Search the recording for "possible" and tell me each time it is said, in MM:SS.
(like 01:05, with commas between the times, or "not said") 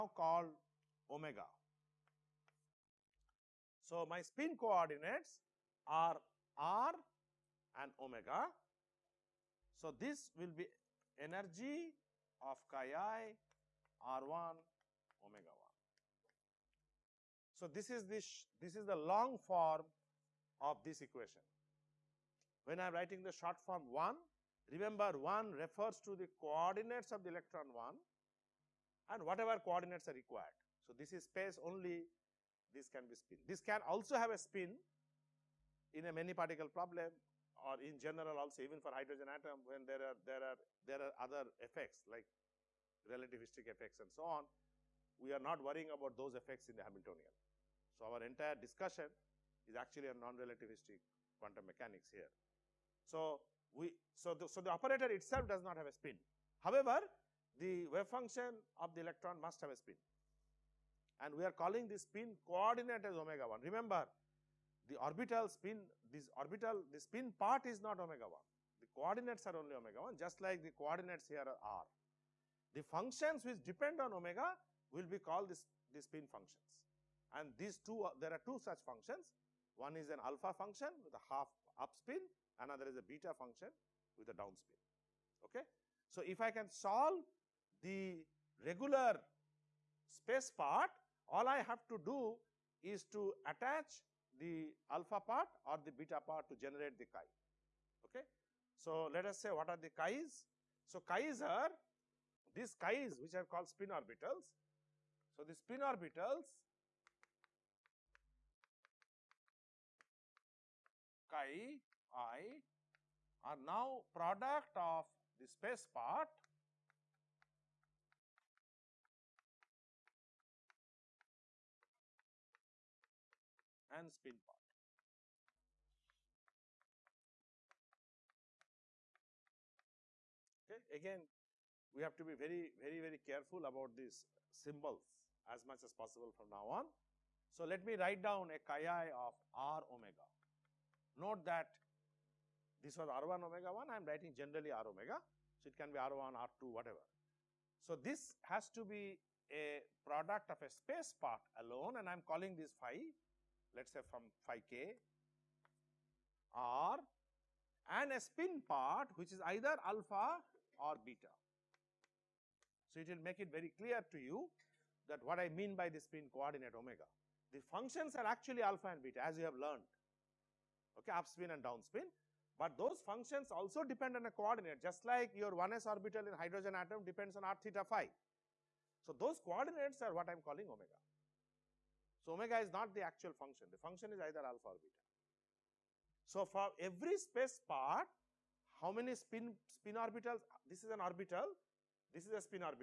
02:15.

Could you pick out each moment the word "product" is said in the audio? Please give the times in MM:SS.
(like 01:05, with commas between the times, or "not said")
01:54, 02:30.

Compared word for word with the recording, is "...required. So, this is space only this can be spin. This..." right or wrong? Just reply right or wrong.
right.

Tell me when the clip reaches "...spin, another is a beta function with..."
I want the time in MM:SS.
01:21.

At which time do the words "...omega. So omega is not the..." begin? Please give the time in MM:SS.
03:00.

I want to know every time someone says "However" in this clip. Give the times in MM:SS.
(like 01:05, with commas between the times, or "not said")
00:56.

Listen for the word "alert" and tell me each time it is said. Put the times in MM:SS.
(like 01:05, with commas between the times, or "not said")
not said.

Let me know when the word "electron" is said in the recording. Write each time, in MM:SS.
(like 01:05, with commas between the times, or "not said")
00:27, 00:59.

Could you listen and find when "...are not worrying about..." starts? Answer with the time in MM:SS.
00:45.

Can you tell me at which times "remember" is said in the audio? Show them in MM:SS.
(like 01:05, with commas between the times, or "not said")
00:24, 01:03.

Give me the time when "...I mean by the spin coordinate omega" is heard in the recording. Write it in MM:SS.
02:45.